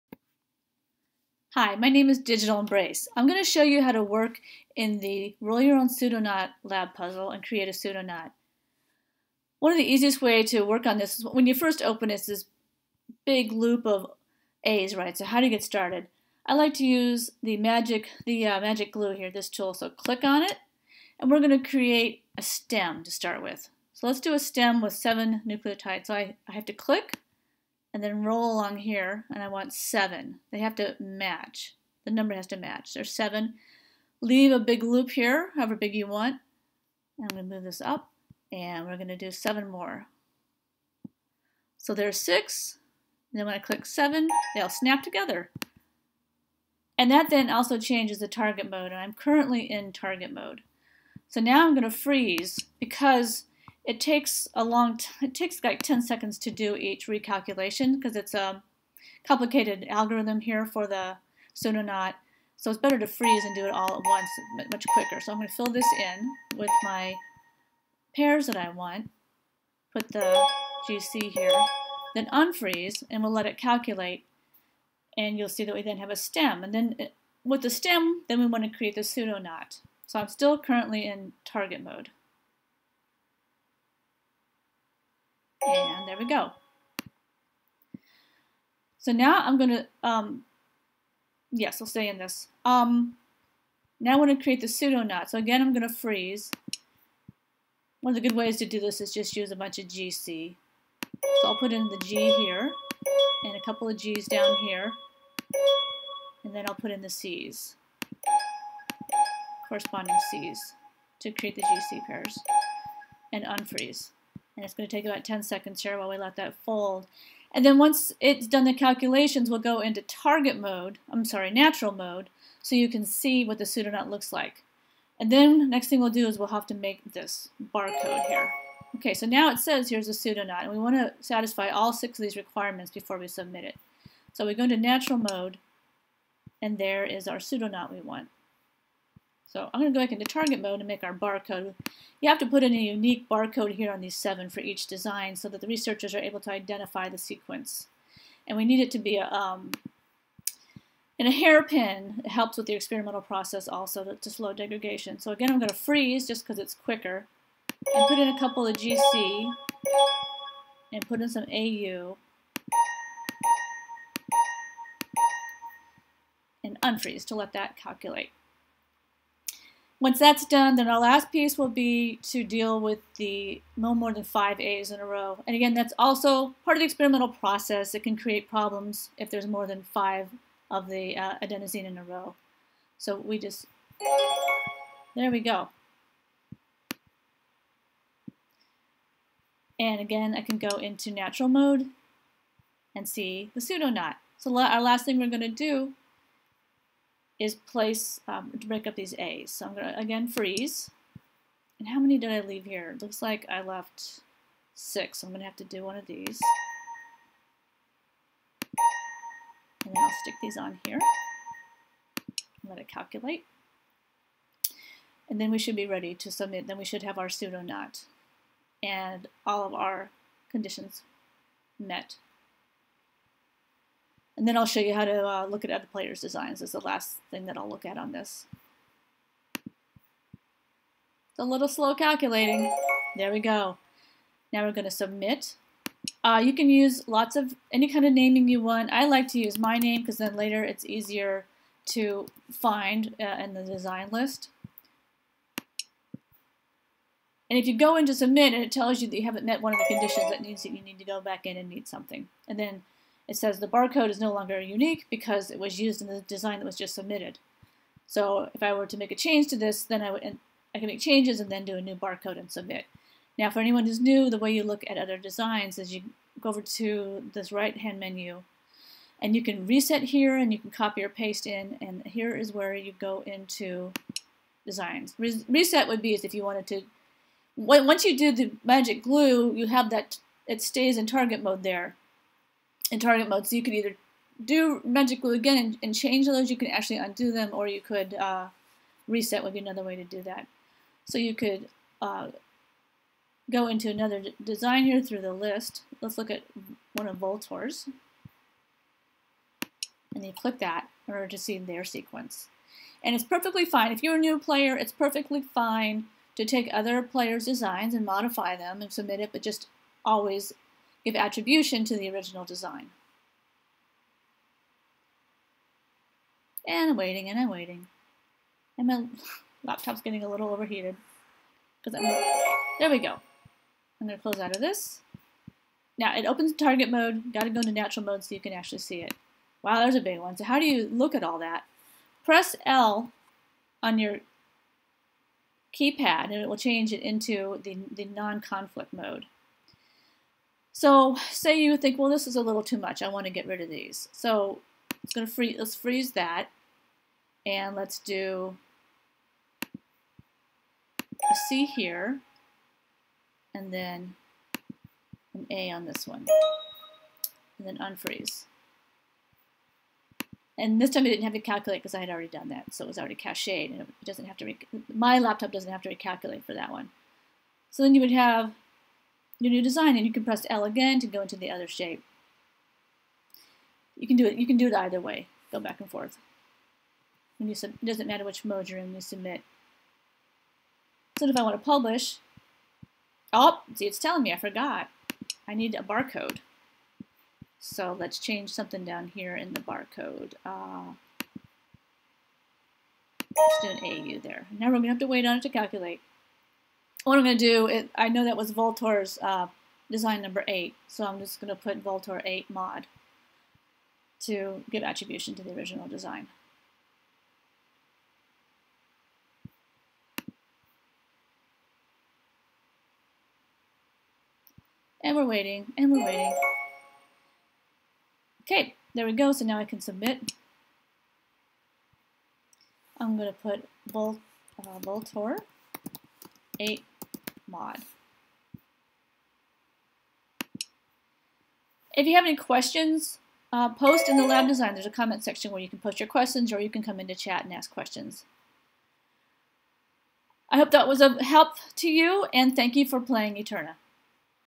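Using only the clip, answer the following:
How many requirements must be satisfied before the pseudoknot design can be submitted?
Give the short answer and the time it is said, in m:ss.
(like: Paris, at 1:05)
6, at 2:11.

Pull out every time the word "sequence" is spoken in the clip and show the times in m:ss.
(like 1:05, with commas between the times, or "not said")
2:27, 5:01.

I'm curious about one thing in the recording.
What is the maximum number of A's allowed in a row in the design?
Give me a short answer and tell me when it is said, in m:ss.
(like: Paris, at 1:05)
5, at 2:53.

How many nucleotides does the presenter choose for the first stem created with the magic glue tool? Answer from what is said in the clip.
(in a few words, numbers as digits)
7.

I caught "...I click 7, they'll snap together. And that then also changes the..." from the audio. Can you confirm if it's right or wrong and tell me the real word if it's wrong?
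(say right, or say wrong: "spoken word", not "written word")
right.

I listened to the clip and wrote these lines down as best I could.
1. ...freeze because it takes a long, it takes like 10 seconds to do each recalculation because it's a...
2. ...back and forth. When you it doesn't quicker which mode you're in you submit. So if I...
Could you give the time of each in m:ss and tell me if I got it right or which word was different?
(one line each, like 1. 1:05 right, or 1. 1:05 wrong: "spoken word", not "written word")
1. 0:51 right
2. 6:15 wrong: "matter", not "quicker".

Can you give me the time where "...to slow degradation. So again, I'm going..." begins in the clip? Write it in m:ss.
2:34.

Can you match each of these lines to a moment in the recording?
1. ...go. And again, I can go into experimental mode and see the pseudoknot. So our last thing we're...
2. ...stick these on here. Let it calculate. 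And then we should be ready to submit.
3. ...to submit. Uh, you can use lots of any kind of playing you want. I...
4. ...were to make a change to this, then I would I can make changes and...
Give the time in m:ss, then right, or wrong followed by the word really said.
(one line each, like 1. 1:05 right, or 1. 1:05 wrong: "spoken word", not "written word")
1. 3:05 wrong: "natural", not "experimental"
2. 3:30 right
3. 3:54 wrong: "naming", not "playing"
4. 4:18 right.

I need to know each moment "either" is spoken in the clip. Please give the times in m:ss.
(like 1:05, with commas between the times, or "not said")
4:43, 6:14.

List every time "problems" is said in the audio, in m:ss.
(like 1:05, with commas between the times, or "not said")
2:58.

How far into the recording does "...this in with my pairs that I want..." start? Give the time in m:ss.
1:05.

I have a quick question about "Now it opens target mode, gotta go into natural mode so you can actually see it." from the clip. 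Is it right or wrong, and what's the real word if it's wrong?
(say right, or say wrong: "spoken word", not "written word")
right.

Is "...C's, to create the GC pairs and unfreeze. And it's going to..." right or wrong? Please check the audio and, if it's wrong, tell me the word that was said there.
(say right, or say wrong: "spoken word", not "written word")
right.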